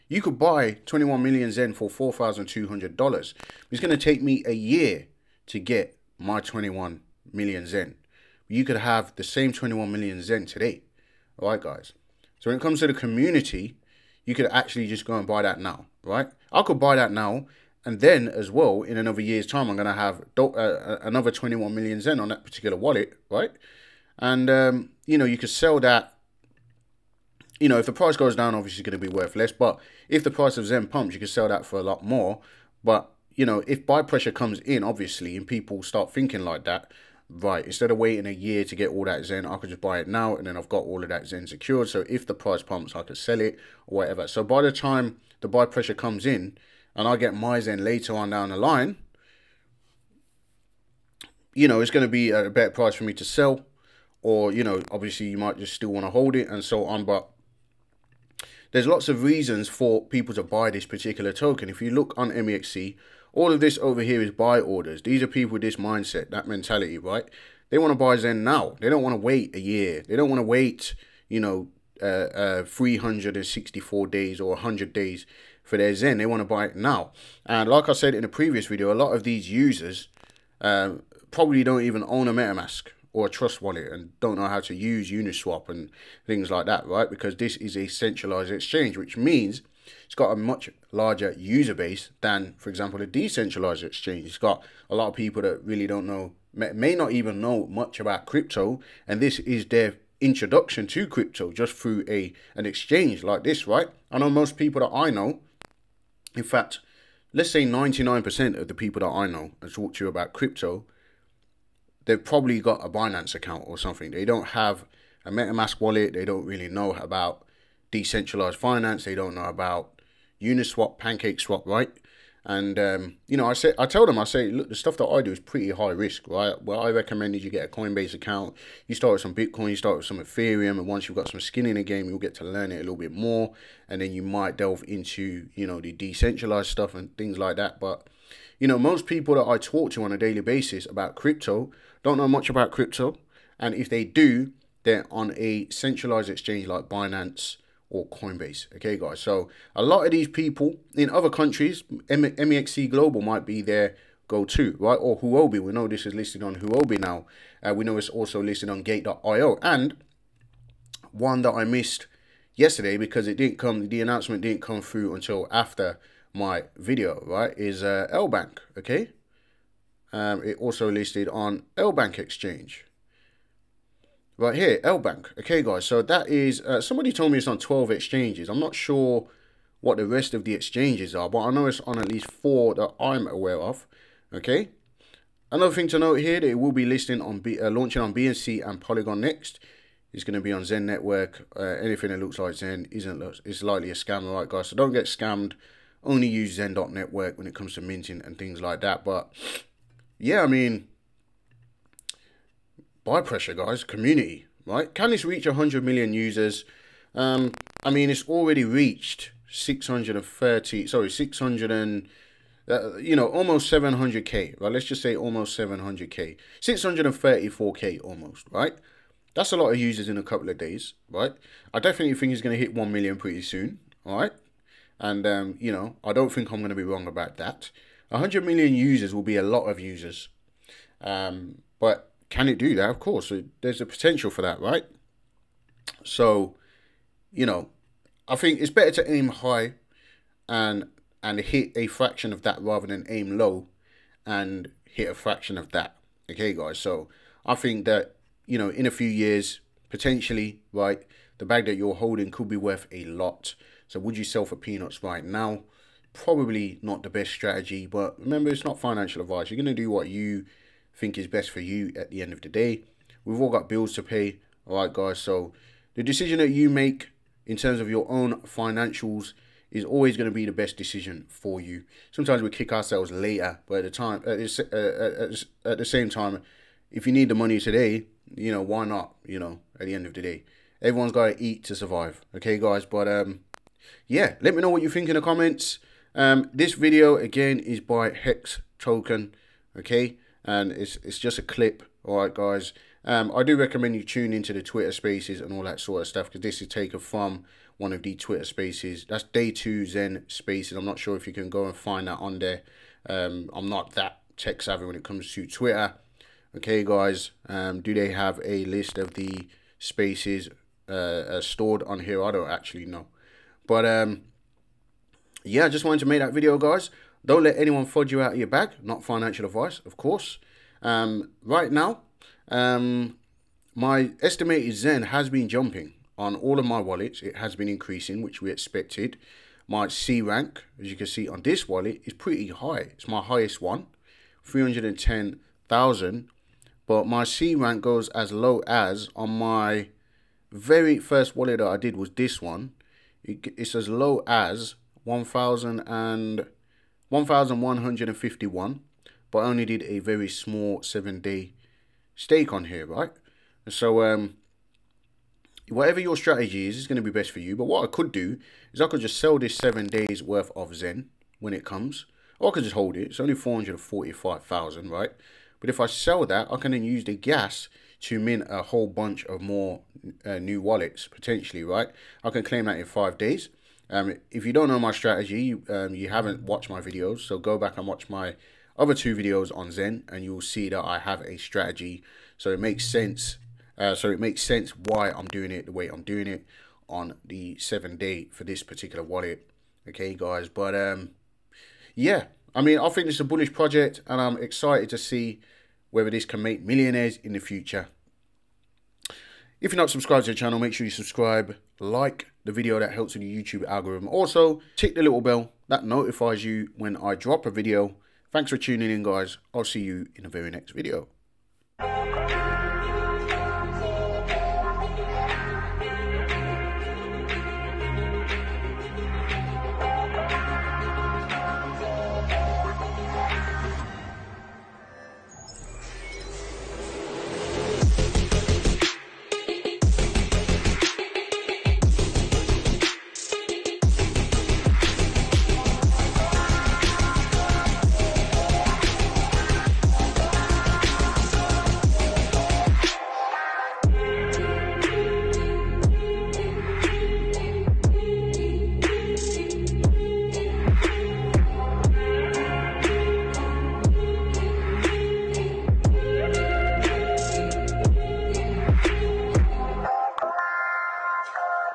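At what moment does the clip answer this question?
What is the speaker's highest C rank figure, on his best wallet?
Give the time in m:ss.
5:34.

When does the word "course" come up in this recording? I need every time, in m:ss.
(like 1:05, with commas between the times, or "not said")
3:52, 5:19.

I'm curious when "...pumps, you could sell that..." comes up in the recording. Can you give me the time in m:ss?
0:30.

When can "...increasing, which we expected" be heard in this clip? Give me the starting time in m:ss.
5:27.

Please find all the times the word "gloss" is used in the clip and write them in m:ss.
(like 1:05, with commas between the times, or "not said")
not said.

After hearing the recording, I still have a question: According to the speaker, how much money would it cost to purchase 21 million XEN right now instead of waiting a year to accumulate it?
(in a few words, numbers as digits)
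$4,200.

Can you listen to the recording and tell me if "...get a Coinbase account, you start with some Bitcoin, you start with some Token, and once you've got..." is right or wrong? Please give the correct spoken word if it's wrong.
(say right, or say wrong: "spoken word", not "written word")
wrong: "Ethereum", not "Token".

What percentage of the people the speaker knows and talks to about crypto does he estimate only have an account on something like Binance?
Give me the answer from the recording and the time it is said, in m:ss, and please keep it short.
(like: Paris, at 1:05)
99%, at 1:47.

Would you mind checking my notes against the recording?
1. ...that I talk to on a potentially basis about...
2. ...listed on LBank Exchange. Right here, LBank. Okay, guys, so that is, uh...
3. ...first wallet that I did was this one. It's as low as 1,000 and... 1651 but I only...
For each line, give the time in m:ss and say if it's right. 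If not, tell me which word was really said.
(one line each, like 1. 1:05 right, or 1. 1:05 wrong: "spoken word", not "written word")
1. 2:19 wrong: "daily", not "potentially"
2. 2:50 right
3. 5:40 wrong: "1151", not "1651".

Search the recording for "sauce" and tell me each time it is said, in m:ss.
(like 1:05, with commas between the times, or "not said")
not said.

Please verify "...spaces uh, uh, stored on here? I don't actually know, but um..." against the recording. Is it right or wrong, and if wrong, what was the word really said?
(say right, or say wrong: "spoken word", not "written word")
right.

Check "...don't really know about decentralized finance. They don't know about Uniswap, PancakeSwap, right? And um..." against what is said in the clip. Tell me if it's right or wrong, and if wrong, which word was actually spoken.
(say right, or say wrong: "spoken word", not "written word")
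right.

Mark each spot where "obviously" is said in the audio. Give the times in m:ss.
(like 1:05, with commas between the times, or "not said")
0:28, 0:34, 0:54.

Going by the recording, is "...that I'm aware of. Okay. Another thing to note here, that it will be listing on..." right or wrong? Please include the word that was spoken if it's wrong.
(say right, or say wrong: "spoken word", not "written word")
right.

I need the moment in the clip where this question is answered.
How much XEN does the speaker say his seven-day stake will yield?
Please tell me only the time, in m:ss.
6:03.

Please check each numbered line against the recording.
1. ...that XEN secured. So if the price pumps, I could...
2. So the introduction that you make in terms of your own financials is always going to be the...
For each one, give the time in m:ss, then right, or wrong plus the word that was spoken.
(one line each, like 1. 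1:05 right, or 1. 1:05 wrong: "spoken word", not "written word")
1. 0:41 right
2. 4:25 wrong: "decision", not "introduction".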